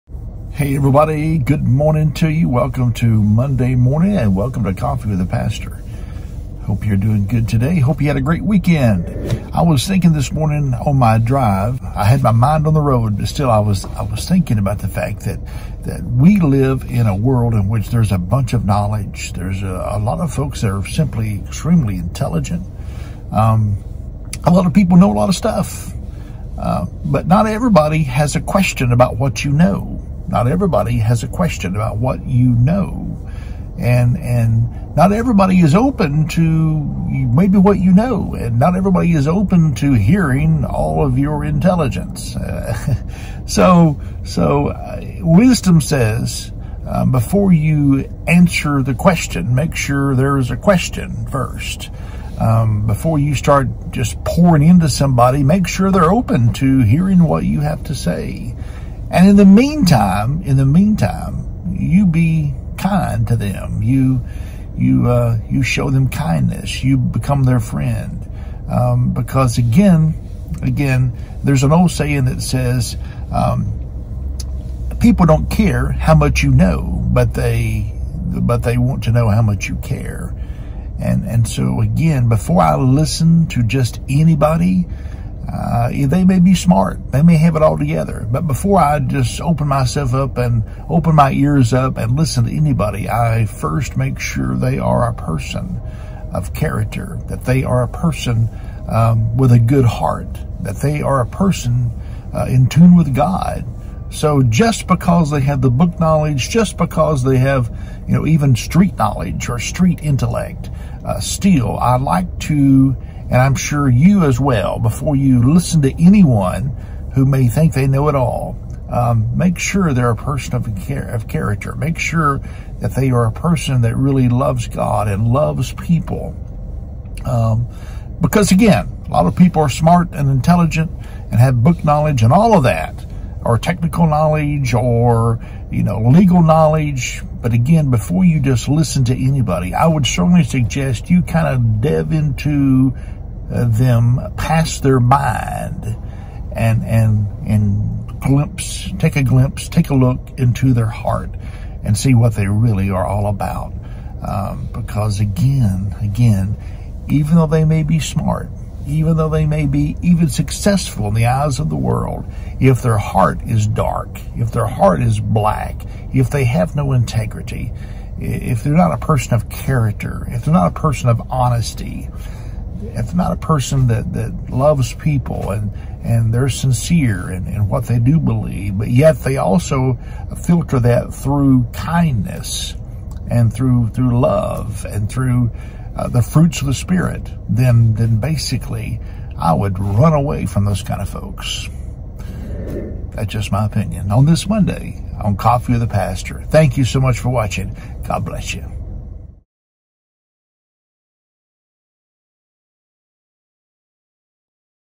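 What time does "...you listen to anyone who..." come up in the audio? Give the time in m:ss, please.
1:55.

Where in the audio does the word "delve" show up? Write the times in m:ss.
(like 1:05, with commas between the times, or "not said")
2:21.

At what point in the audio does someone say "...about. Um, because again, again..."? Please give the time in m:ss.
2:33.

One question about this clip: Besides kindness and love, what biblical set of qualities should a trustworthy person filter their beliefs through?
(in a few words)
the fruits of the Spirit.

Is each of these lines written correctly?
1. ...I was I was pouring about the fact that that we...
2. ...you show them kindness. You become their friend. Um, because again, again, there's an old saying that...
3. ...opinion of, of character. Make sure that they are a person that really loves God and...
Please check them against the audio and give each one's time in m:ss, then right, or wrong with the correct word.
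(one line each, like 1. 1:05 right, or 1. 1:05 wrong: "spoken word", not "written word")
1. 0:13 wrong: "thinking", not "pouring"
2. 1:05 right
3. 2:00 wrong: "person", not "opinion".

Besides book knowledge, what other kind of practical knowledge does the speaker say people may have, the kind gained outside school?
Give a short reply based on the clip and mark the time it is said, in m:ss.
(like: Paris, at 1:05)
street knowledge, at 1:48.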